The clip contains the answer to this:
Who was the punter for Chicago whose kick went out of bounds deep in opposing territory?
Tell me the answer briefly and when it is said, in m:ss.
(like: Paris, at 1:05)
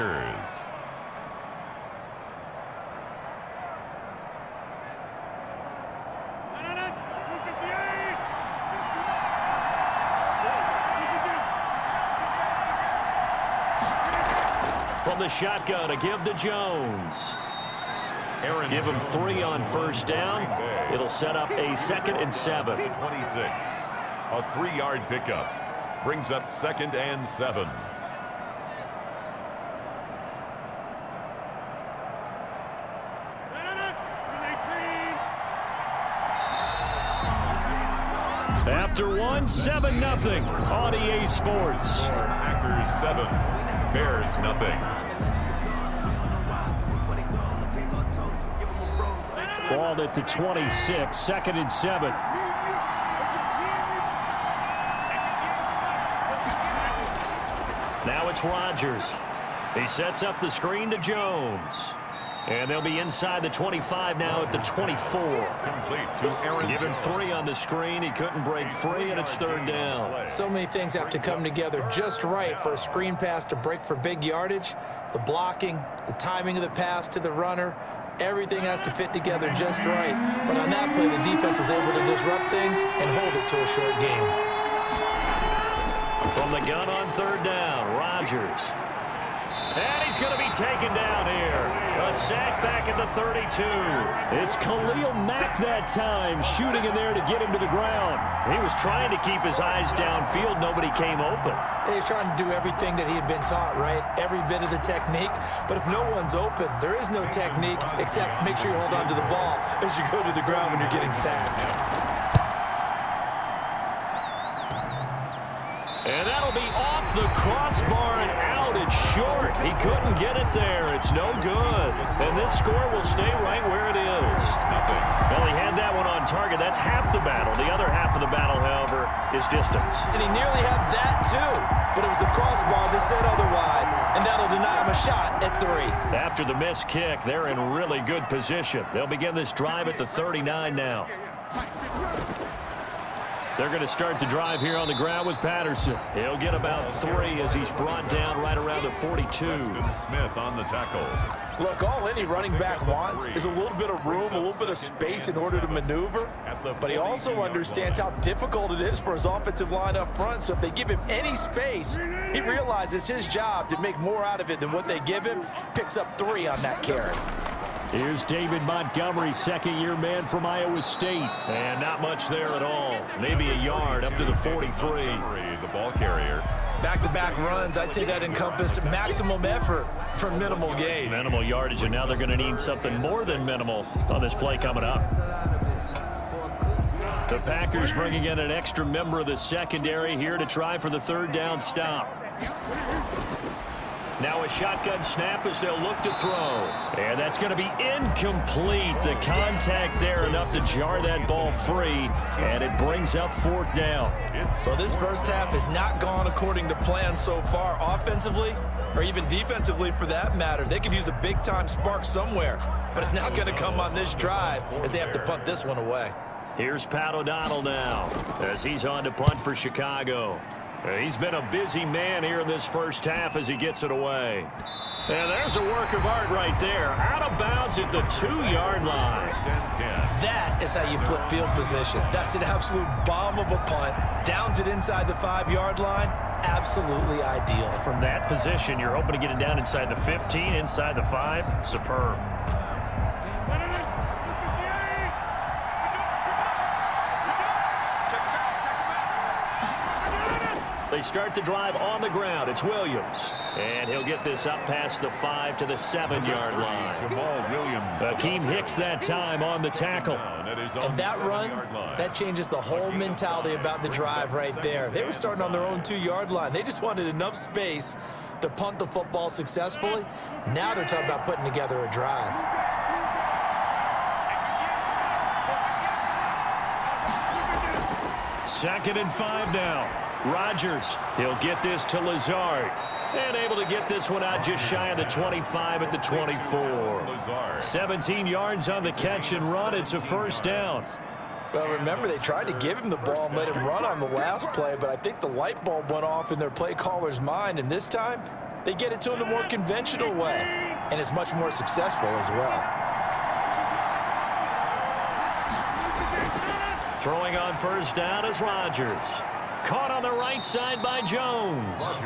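Pat O'Donnell, at 3:36.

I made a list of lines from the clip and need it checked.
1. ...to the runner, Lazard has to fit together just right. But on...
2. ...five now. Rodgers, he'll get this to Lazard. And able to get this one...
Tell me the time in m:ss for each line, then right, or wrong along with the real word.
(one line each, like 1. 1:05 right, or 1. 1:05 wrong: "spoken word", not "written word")
1. 1:17 wrong: "Everything", not "Lazard"
2. 4:39 right.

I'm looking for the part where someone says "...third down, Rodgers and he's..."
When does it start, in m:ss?
1:27.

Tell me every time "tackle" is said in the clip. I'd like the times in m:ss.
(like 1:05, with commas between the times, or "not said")
2:30, 4:19.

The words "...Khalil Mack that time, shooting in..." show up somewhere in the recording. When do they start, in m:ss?
1:34.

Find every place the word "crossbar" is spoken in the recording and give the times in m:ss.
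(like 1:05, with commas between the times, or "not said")
1:57, 2:12.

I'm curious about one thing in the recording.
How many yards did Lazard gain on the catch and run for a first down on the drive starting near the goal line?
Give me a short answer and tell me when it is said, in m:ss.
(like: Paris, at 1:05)
17, at 4:47.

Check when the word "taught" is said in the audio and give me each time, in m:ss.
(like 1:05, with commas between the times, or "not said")
1:43.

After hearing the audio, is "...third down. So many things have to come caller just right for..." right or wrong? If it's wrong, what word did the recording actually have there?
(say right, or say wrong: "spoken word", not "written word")
wrong: "together", not "caller".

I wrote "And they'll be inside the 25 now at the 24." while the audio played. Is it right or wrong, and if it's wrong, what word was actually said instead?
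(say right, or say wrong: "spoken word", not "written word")
right.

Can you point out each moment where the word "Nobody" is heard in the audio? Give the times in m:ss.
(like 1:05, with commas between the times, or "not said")
1:40.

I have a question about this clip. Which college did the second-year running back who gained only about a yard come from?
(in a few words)
Iowa State.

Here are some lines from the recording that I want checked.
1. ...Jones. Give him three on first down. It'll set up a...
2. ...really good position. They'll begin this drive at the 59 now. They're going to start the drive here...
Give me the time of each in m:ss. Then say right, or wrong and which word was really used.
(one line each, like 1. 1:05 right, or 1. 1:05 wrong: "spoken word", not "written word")
1. 0:16 right
2. 2:17 wrong: "39", not "59".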